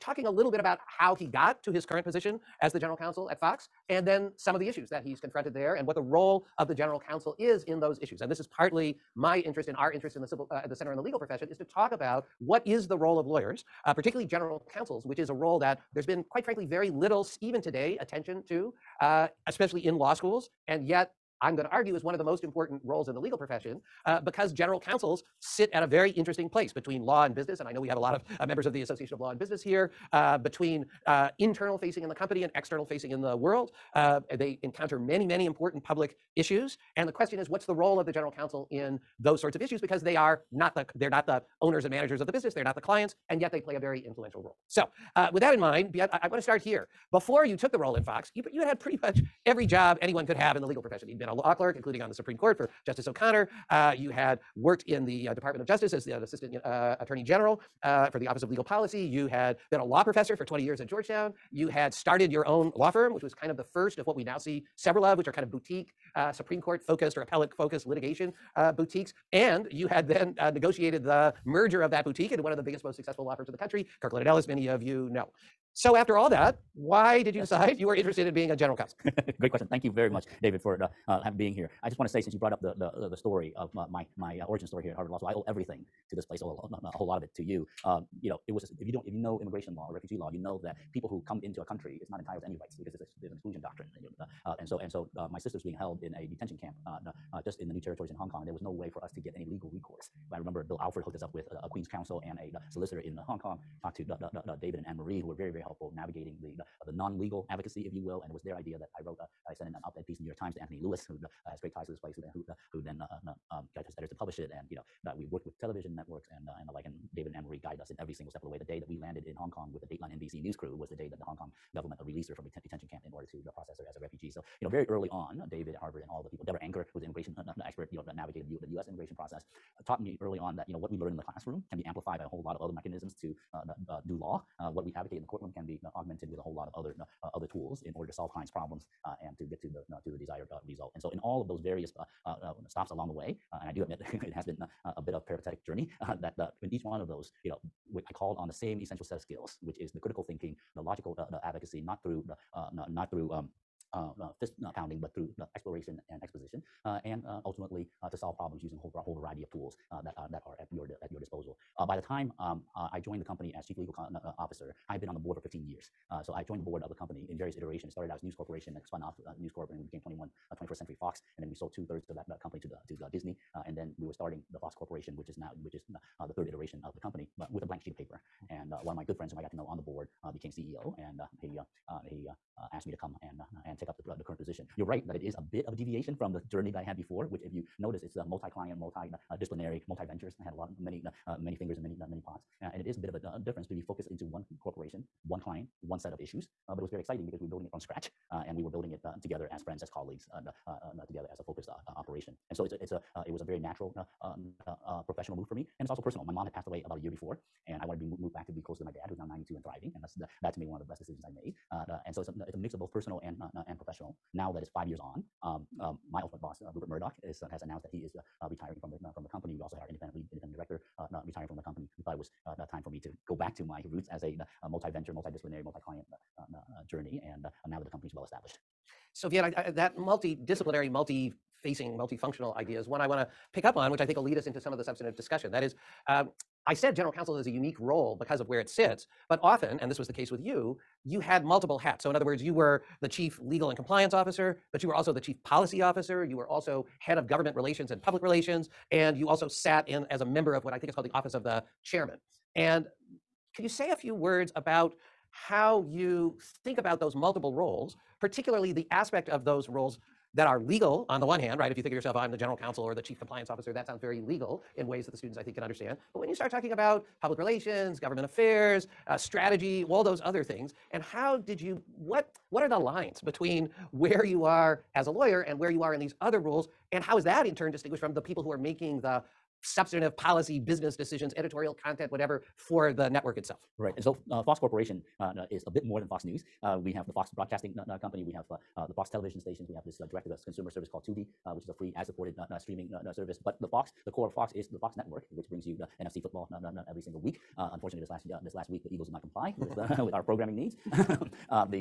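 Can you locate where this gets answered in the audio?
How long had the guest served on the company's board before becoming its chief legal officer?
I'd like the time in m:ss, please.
2:45.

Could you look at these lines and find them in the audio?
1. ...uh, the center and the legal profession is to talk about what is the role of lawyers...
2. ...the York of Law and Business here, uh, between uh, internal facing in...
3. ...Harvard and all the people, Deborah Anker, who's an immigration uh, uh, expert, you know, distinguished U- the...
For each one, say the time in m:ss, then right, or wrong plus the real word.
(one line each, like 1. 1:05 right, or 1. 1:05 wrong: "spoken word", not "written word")
1. 0:10 right
2. 0:28 wrong: "Association", not "York"
3. 2:05 wrong: "navigated", not "distinguished".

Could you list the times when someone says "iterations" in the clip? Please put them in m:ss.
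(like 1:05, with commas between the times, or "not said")
2:47, 2:56.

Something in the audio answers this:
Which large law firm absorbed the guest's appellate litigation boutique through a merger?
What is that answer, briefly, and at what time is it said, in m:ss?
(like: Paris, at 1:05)
Kirkland and Ellis, at 1:14.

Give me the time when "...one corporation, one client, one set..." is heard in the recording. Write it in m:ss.
3:14.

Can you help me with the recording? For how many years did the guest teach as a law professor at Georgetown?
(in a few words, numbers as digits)
20.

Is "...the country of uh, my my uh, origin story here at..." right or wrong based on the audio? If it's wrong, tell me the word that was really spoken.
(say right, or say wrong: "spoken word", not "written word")
wrong: "story", not "country".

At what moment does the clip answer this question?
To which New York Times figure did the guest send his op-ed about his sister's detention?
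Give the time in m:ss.
1:50.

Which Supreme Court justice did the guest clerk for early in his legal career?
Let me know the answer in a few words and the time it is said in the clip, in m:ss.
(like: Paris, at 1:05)
Justice O'Connor, at 0:52.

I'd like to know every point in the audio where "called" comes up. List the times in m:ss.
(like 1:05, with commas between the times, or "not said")
2:28, 4:10, 4:50.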